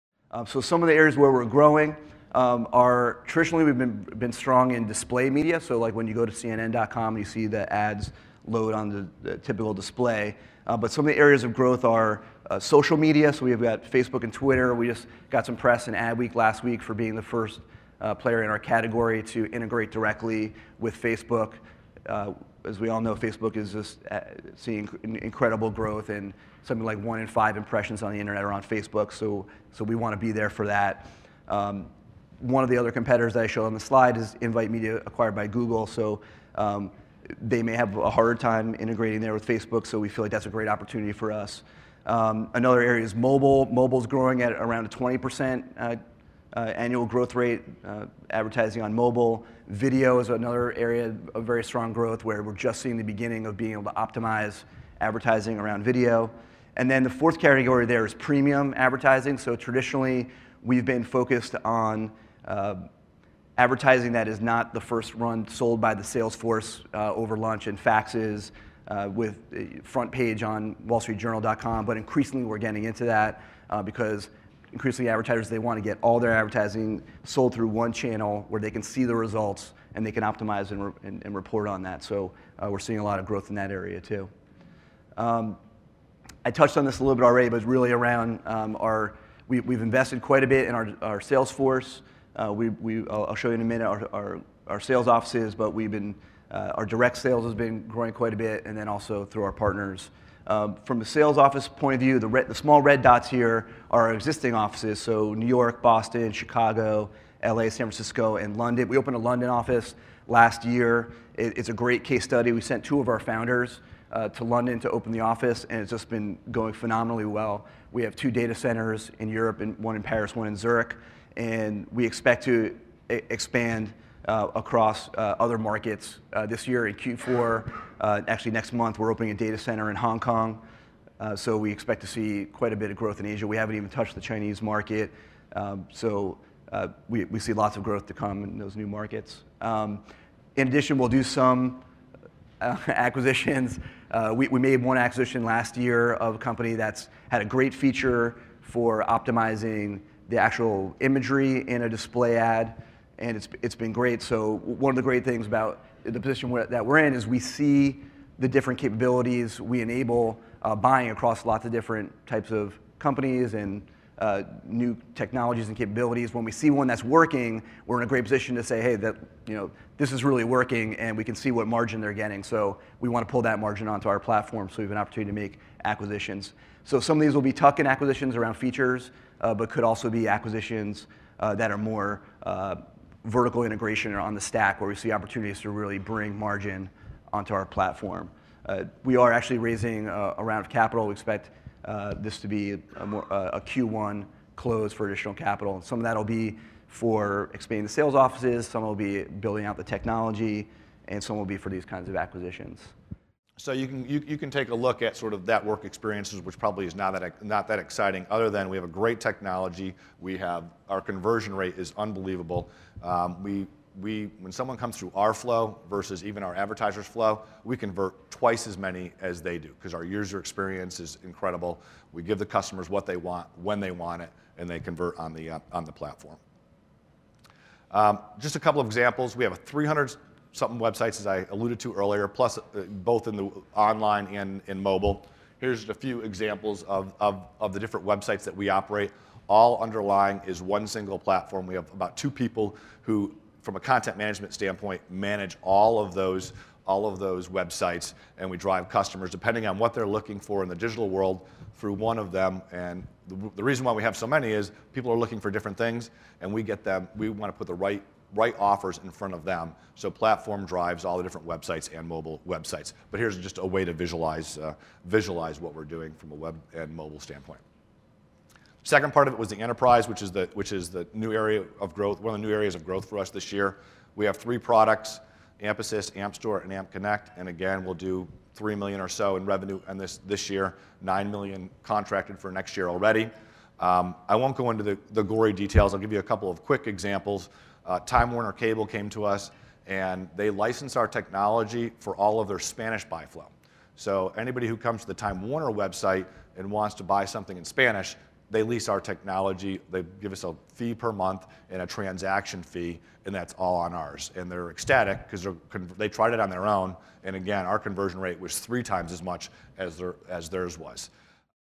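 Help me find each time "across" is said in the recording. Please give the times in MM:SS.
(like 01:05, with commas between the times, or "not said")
02:04, 02:41.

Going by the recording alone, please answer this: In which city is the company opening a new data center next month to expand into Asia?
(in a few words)
Hong Kong.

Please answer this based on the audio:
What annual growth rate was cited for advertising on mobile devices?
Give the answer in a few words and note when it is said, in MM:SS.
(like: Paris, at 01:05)
20%, at 00:44.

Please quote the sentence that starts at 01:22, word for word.
So uh, we're seeing a lot of growth in that area too.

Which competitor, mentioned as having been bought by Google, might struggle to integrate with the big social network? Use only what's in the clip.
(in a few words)
Invite Media.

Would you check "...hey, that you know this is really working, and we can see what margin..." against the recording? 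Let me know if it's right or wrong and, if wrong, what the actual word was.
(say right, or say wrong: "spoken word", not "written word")
right.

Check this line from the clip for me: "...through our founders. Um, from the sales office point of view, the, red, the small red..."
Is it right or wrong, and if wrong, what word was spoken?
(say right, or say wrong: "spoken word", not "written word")
wrong: "partners", not "founders".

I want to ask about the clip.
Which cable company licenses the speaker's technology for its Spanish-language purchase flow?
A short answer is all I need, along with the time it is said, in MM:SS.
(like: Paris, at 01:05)
Time Warner Cable, at 04:48.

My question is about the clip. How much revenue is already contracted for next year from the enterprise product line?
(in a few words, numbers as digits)
9 million.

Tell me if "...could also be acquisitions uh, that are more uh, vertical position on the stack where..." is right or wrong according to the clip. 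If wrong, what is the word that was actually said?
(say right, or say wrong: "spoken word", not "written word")
wrong: "integration", not "position".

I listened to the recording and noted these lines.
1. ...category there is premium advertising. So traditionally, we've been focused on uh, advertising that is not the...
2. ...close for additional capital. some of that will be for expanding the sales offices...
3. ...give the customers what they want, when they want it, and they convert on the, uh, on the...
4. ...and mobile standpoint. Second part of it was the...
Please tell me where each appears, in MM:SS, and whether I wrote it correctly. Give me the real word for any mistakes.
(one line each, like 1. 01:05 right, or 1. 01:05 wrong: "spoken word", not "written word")
1. 00:57 right
2. 03:14 right
3. 03:42 right
4. 04:26 right.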